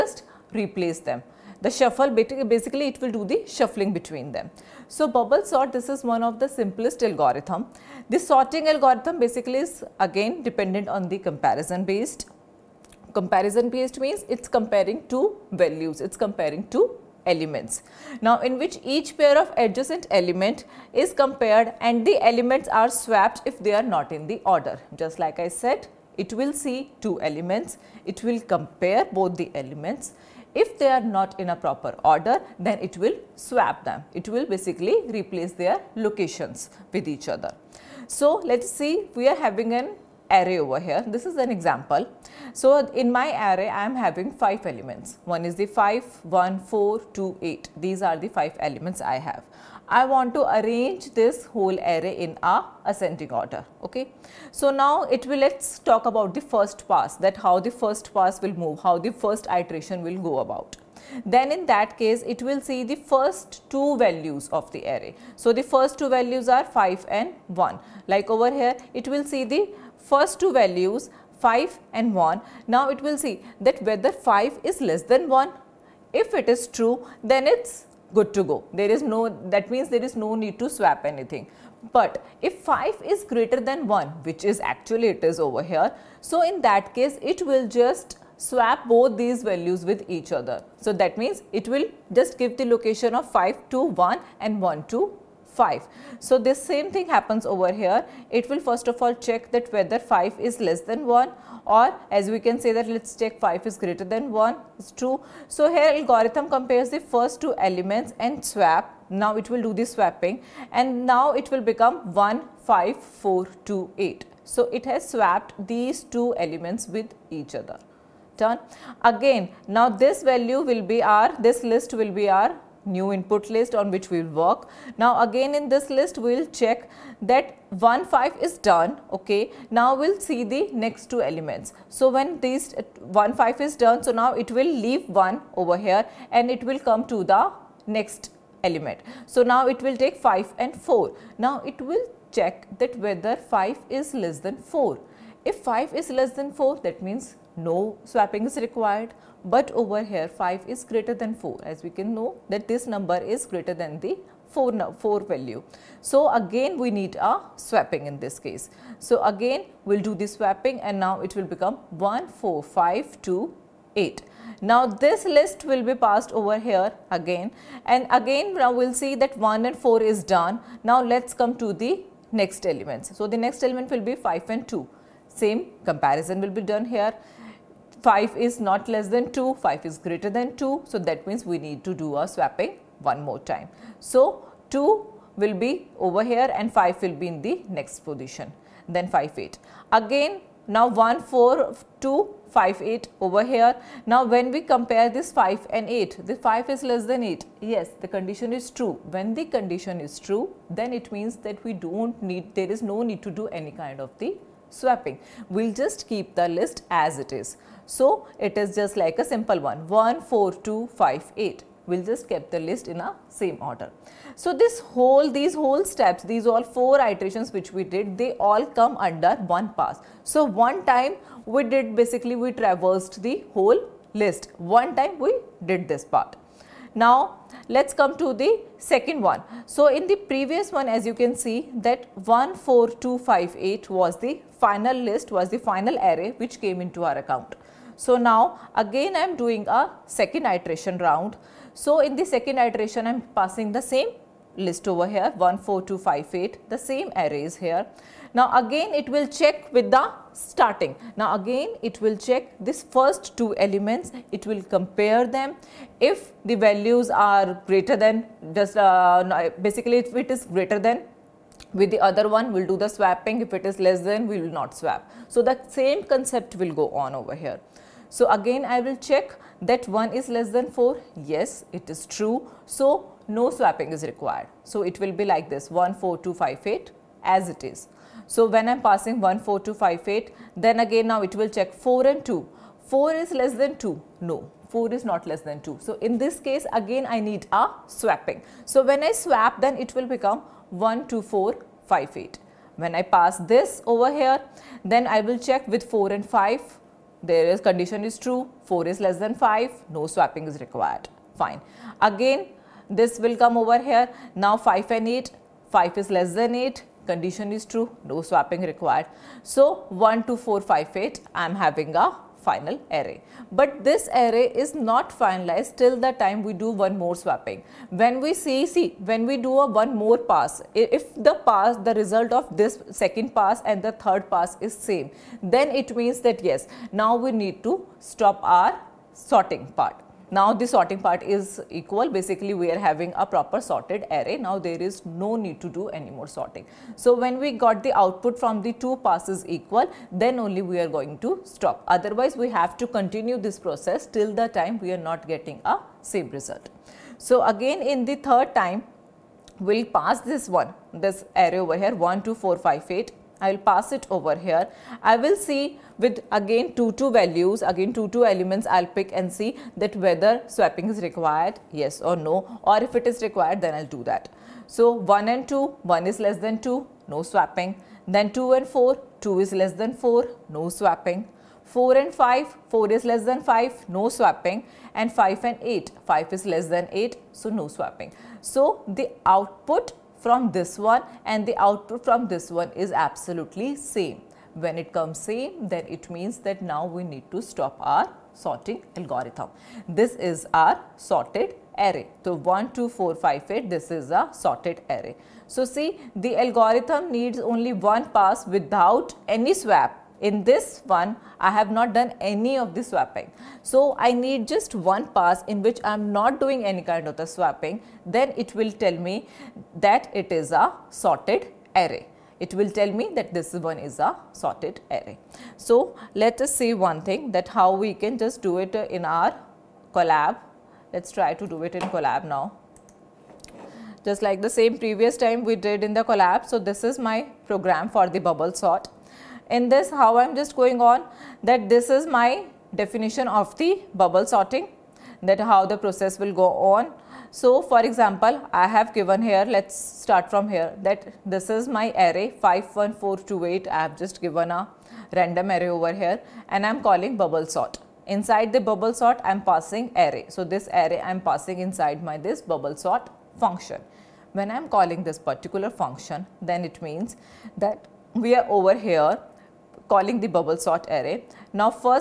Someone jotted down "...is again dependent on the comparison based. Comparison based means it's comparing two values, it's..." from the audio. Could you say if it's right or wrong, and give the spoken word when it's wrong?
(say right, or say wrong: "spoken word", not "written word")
right.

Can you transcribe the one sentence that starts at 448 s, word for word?
Inside the bubble sort, I am passing array.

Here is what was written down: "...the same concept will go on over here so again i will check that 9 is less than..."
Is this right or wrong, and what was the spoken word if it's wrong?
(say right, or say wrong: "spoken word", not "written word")
wrong: "1", not "9".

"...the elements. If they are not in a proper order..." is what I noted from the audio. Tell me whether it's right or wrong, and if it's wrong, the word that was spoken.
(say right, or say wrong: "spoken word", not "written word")
right.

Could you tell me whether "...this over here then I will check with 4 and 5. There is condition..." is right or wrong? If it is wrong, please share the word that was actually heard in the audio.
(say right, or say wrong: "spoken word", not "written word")
right.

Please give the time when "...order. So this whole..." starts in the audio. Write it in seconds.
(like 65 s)
213 s.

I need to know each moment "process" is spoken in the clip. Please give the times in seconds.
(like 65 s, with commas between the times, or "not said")
343 s, 435 s.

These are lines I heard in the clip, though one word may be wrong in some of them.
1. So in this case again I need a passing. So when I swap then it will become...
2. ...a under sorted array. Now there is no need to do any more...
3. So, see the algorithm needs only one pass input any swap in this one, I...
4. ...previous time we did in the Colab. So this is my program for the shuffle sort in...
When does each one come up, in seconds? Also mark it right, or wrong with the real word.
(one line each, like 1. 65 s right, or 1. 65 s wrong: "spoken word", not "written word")
1. 285 s wrong: "swapping", not "passing"
2. 333 s wrong: "proper", not "under"
3. 395 s wrong: "without", not "input"
4. 424 s wrong: "bubble", not "shuffle".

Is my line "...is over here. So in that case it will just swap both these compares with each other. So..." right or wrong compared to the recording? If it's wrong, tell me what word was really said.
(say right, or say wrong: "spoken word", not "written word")
wrong: "values", not "compares".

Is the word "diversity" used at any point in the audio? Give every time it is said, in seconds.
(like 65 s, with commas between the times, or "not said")
not said.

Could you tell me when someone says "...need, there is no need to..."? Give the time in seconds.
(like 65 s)
202 s.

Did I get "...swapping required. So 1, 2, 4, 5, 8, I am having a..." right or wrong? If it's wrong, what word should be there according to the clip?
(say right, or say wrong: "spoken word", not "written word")
right.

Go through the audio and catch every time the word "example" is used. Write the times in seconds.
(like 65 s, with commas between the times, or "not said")
41 s, 437 s.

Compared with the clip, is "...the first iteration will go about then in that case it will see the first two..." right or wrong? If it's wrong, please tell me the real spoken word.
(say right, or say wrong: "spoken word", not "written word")
right.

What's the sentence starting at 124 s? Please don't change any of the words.
Now again in this list we will check that 1 5 is done okay.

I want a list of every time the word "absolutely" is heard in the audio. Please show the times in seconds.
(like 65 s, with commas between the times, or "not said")
383 s.